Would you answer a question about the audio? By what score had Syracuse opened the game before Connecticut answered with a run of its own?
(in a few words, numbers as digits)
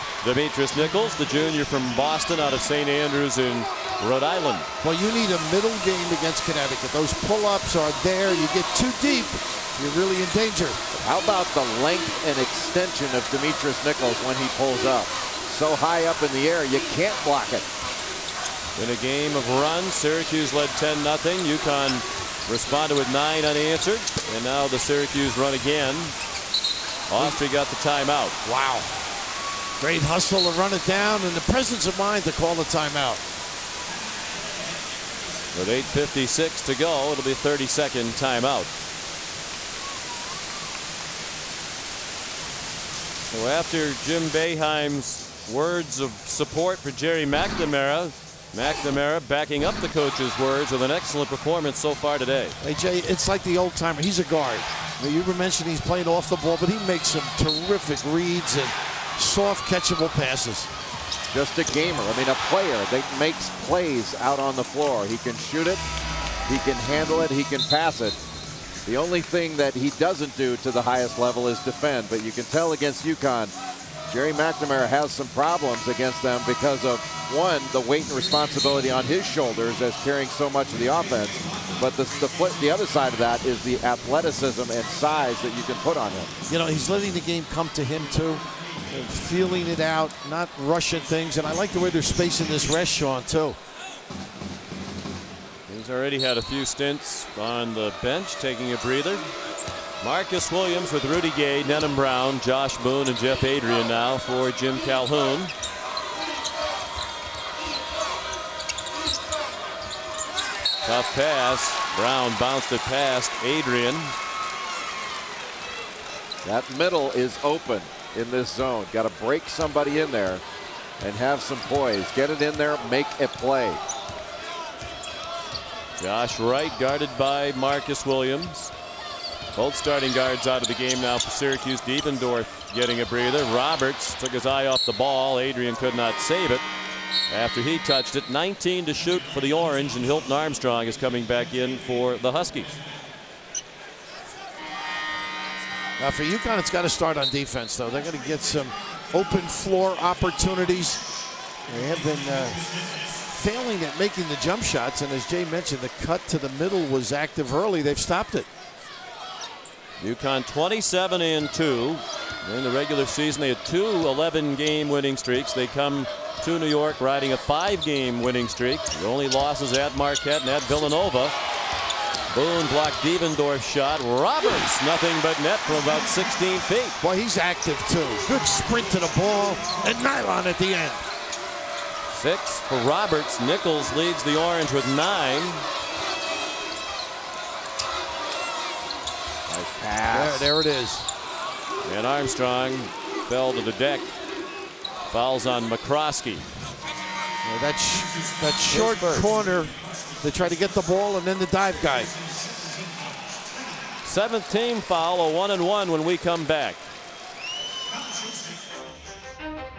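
10-0.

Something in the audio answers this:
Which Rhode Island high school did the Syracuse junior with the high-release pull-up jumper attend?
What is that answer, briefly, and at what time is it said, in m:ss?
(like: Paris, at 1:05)
St. Andrews, at 0:02.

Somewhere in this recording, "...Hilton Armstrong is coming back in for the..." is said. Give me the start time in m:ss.
2:20.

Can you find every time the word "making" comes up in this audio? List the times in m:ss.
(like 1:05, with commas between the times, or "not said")
2:33.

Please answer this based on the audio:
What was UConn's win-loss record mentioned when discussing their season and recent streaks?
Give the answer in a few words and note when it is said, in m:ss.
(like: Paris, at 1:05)
27 and 2, at 2:40.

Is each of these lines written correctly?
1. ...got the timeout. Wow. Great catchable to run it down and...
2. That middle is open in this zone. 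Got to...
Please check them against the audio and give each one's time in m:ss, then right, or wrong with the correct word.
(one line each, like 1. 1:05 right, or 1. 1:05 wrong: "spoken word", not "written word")
1. 0:27 wrong: "hustle", not "catchable"
2. 1:56 right.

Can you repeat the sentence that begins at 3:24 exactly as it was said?
Seventh team foul, a one and one when we come back.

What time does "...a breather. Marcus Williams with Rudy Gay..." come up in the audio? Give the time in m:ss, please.
1:38.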